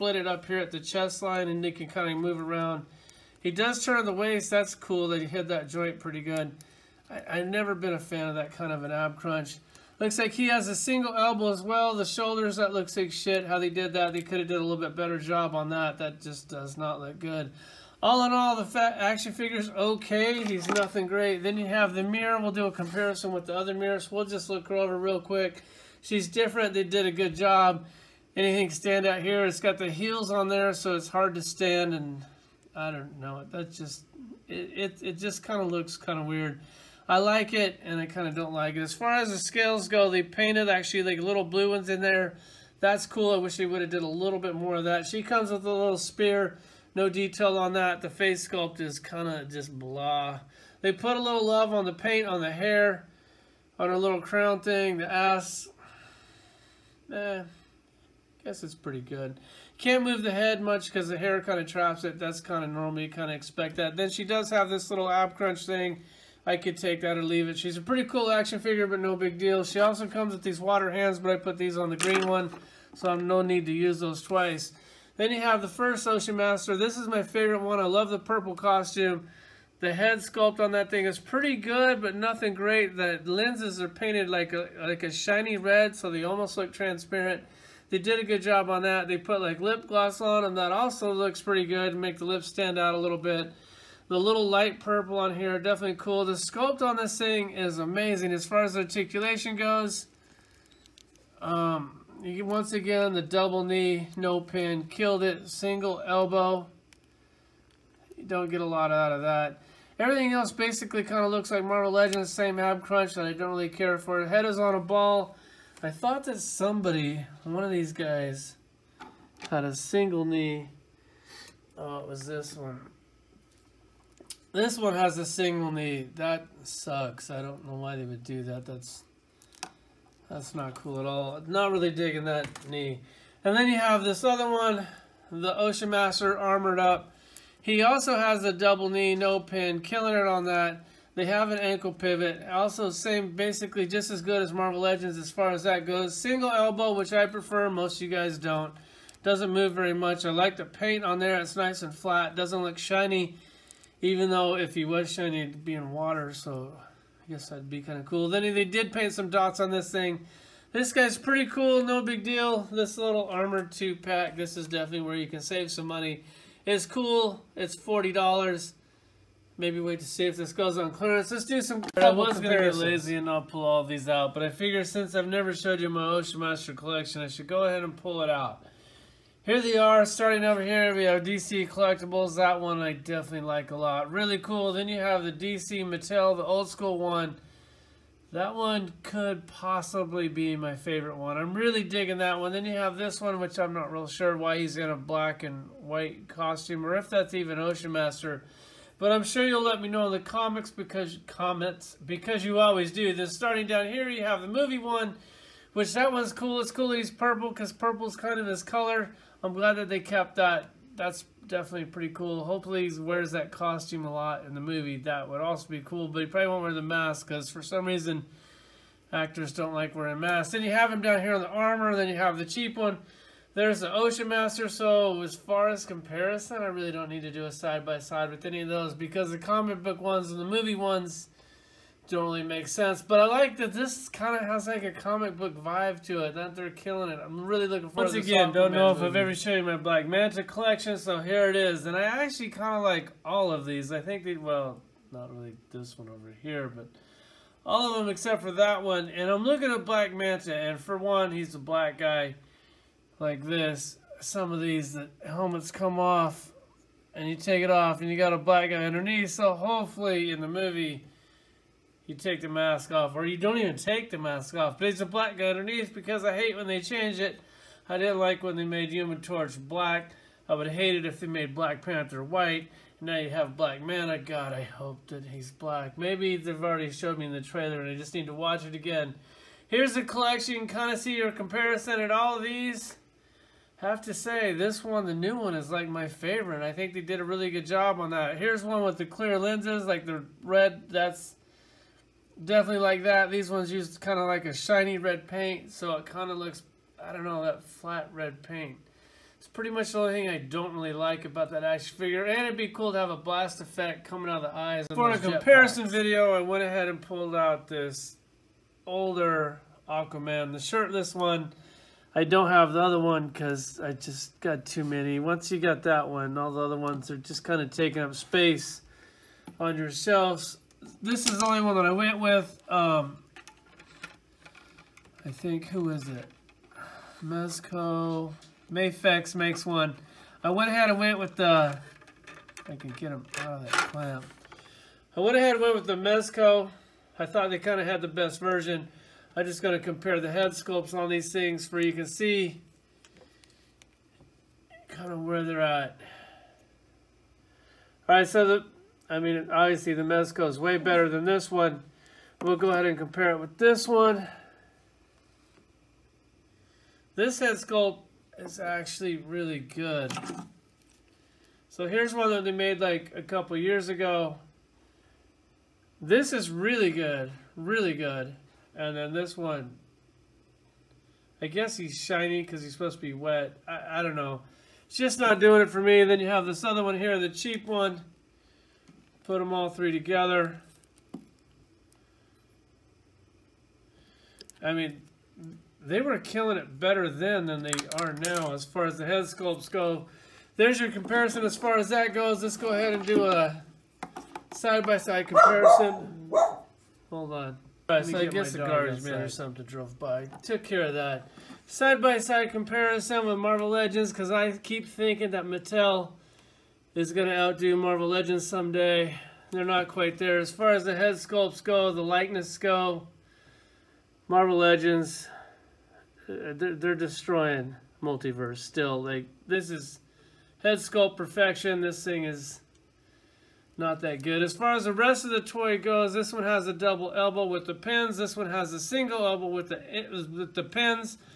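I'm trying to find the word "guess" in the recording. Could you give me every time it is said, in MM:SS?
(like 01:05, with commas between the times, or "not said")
00:58, 02:37, 06:11, 06:38.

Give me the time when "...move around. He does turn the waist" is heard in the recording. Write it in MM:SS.
00:02.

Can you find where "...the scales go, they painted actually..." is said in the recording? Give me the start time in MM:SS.
00:39.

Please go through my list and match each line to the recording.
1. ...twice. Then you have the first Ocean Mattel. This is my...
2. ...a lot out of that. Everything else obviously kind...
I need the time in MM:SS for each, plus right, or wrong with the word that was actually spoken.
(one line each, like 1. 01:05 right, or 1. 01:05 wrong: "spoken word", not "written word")
1. 01:14 wrong: "Master", not "Mattel"
2. 01:48 wrong: "basically", not "obviously".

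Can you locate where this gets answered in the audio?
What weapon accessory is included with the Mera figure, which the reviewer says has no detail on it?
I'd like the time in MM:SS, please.
00:45.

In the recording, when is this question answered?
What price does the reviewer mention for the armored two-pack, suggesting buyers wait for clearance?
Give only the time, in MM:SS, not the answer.
02:47.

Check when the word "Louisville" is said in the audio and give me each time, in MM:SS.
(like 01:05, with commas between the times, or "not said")
not said.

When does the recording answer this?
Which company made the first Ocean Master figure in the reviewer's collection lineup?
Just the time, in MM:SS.
03:01.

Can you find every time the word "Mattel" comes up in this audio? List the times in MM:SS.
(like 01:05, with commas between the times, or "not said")
03:05, 06:45.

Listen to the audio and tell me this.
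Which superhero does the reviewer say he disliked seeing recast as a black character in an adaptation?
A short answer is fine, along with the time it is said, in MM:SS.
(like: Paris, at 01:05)
Human Torch, at 04:28.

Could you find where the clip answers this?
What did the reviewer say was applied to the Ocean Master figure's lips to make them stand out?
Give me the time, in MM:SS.
01:29.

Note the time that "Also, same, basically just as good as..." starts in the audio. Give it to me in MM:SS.
02:22.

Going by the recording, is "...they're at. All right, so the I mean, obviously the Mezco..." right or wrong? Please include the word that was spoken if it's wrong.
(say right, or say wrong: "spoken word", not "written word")
right.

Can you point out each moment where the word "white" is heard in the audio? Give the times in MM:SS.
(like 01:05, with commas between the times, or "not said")
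03:15, 04:32.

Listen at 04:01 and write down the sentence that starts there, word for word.
And I actually kind of like all of these.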